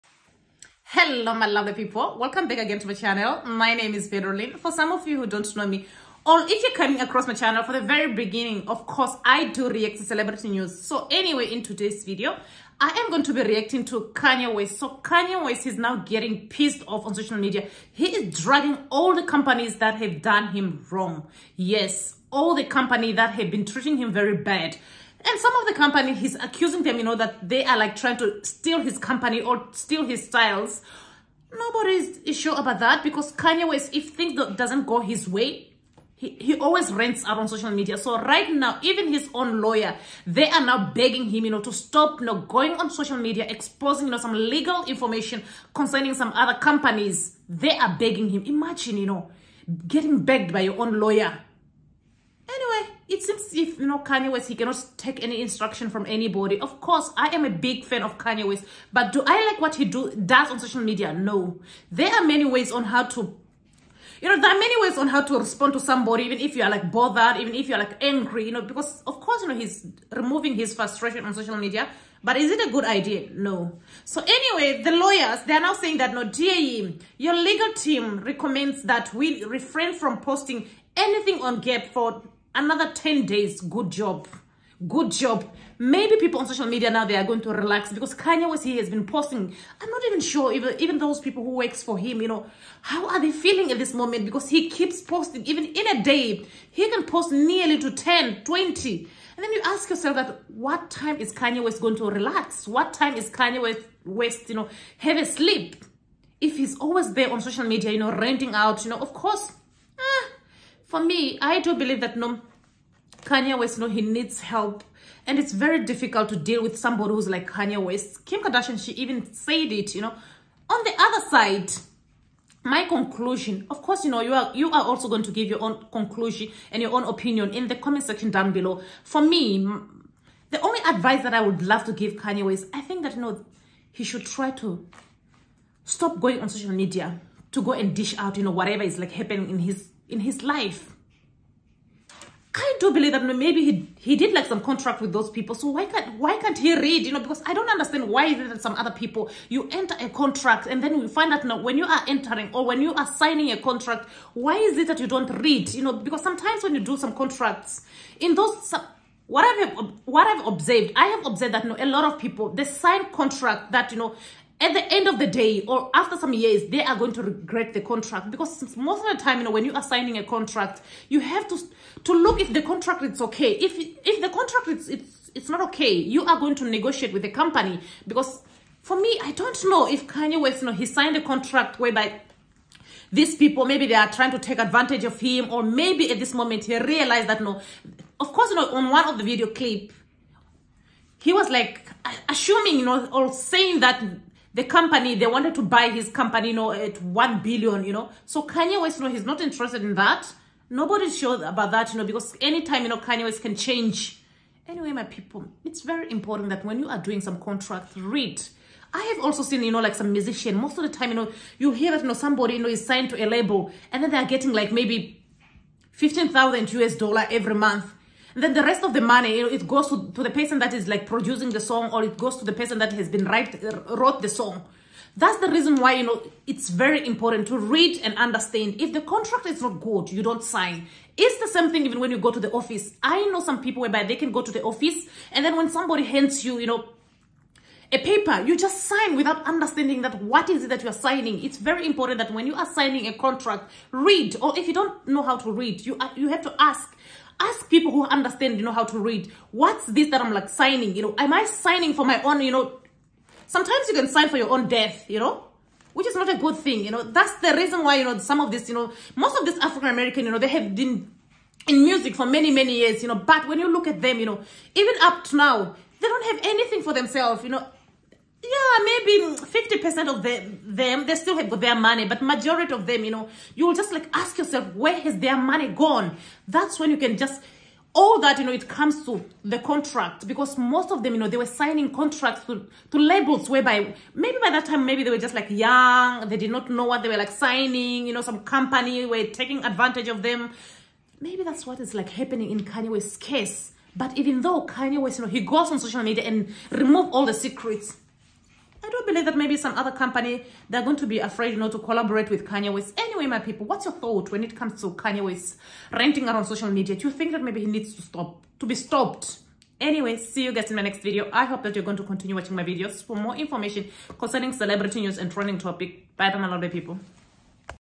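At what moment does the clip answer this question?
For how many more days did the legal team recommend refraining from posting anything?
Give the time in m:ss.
1:22.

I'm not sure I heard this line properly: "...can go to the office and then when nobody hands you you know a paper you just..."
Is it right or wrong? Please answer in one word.
wrong.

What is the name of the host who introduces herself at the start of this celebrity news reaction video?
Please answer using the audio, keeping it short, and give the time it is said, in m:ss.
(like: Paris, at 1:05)
Lynn, at 0:04.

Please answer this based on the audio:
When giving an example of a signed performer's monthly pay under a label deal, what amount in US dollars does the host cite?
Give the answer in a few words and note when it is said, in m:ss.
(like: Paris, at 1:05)
15,000, at 3:35.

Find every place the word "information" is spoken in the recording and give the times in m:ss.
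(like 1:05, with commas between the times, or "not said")
0:44, 5:13.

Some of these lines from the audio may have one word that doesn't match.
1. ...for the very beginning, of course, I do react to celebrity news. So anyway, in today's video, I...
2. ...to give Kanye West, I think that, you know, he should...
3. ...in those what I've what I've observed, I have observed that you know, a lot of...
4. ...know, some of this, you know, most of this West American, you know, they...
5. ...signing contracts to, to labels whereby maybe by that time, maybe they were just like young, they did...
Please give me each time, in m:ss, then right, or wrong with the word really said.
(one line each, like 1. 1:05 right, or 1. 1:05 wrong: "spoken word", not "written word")
1. 0:07 right
2. 2:11 right
3. 2:38 right
4. 4:18 wrong: "African", not "West"
5. 4:41 right.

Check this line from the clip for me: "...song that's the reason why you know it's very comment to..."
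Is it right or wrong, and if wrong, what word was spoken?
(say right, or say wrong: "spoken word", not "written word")
wrong: "important", not "comment".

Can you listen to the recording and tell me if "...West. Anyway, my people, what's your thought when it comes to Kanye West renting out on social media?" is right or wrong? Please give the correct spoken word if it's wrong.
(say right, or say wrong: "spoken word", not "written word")
right.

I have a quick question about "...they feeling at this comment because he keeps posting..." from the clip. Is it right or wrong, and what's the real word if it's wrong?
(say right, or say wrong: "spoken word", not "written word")
wrong: "moment", not "comment".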